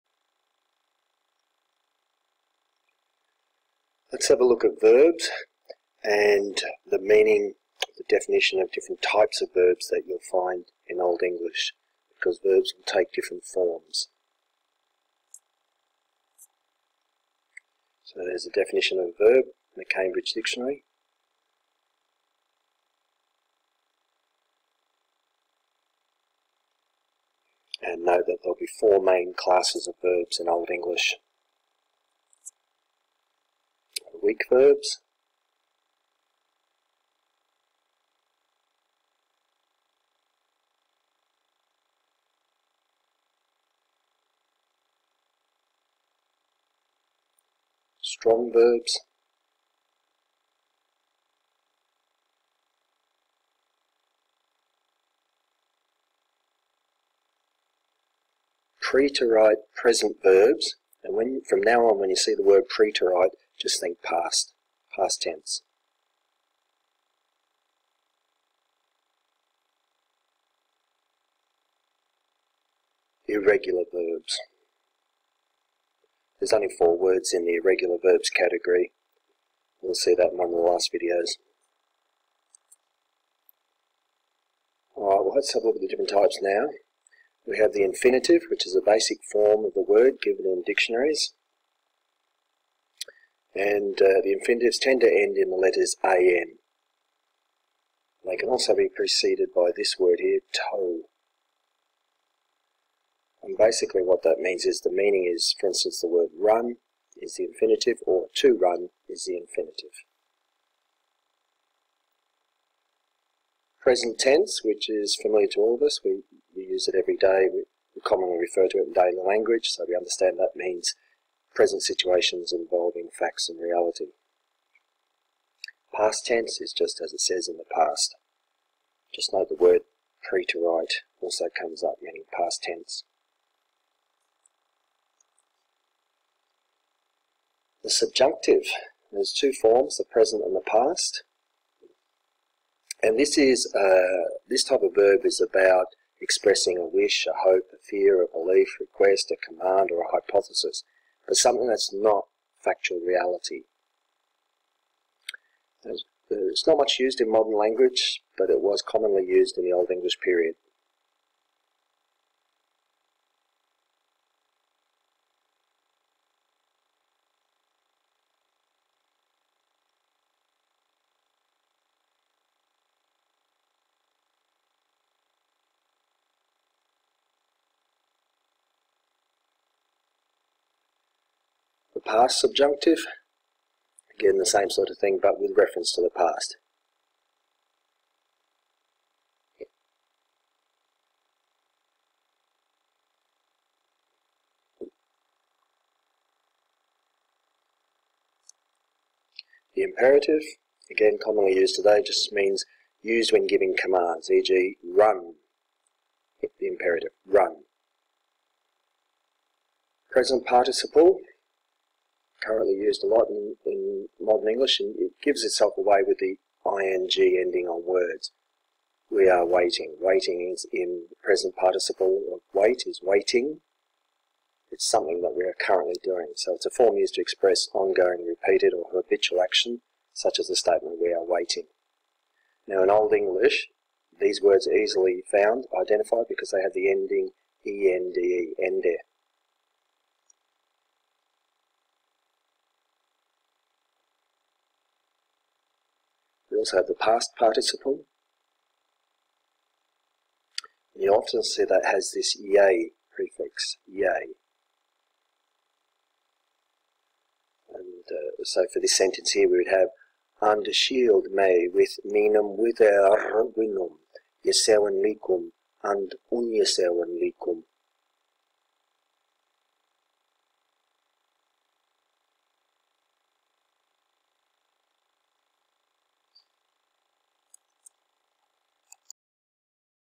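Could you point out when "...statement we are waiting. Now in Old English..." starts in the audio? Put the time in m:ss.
3:50.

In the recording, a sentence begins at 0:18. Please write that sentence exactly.
So there's a definition of a verb in the Cambridge Dictionary.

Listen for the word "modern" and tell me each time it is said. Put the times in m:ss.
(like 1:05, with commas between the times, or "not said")
2:37, 3:34.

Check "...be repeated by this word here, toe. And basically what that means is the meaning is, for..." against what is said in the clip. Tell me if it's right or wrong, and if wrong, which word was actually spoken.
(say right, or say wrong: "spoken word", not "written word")
wrong: "preceded", not "repeated".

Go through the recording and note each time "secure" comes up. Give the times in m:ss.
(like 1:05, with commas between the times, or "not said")
not said.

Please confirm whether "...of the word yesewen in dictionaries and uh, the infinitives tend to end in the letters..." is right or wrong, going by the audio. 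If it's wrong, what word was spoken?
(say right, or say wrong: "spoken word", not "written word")
wrong: "given", not "yesewen".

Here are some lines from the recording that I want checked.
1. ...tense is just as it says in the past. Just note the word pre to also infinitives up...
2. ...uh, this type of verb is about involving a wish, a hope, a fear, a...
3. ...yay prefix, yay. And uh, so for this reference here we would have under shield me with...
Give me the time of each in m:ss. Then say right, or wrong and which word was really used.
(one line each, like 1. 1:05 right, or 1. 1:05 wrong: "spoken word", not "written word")
1. 2:06 wrong: "comes", not "infinitives"
2. 2:23 wrong: "expressing", not "involving"
3. 4:12 wrong: "sentence", not "reference".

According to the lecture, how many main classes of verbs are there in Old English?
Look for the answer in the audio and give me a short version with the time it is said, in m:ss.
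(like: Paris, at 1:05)
4, at 0:28.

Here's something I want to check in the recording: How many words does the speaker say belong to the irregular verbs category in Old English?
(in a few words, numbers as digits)
4.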